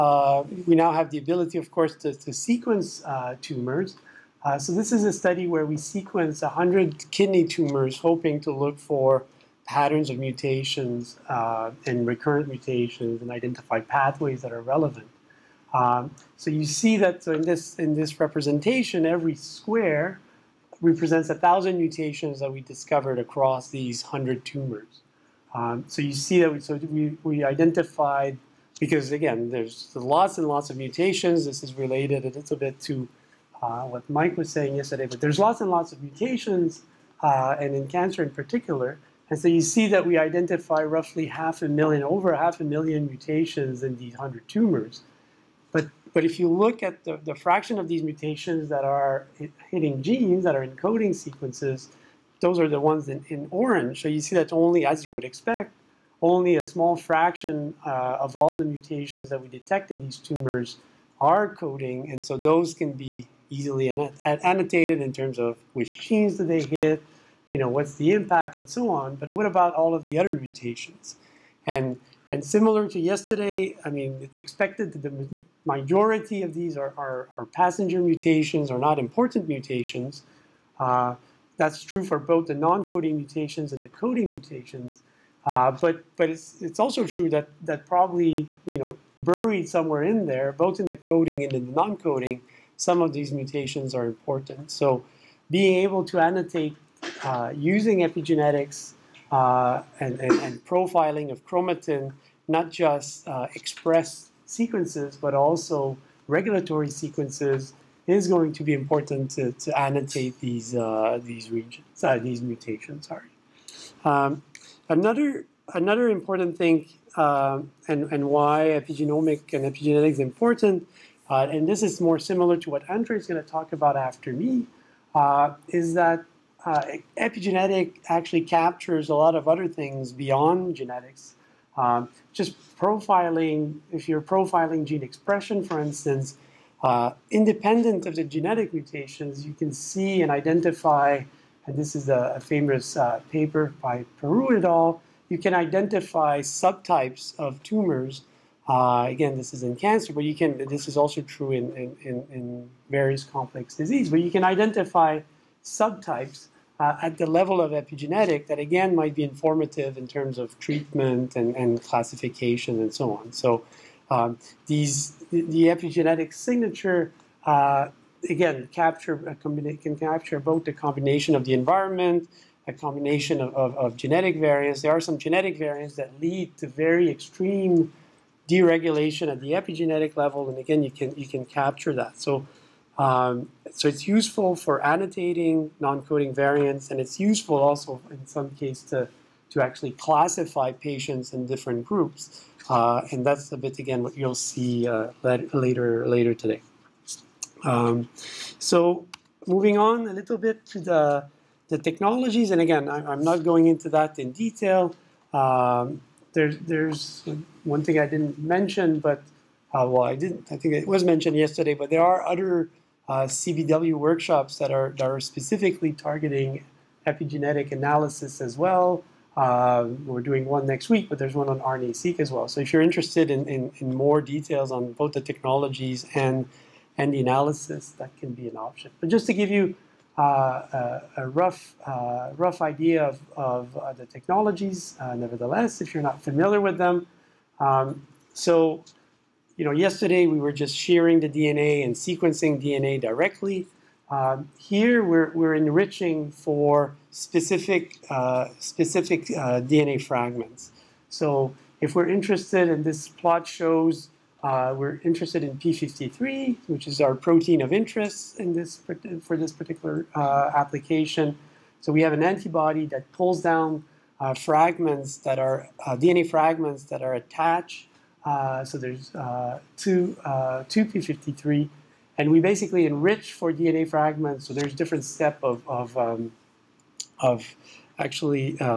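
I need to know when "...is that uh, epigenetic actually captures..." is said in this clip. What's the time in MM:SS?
02:05.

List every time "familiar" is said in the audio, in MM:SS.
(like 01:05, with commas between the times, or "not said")
03:56.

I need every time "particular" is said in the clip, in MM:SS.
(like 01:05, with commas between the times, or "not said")
00:38, 04:19.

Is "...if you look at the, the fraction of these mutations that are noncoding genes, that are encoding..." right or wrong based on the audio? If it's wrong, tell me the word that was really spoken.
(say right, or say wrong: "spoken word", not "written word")
wrong: "hitting", not "noncoding".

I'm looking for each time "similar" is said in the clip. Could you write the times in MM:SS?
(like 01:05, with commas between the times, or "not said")
01:12, 02:02.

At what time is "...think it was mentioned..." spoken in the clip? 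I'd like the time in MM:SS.
03:30.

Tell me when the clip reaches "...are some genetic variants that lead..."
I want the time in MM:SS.
02:54.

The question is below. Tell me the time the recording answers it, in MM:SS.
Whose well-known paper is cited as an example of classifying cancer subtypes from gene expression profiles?
02:24.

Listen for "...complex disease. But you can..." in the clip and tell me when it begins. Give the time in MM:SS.
02:33.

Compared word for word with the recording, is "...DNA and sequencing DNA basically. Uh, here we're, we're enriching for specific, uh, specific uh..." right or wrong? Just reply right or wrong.
wrong.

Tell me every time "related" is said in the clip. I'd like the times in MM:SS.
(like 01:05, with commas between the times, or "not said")
00:31.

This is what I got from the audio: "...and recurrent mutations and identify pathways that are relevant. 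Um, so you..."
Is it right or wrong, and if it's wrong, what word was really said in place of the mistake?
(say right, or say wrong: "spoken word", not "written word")
right.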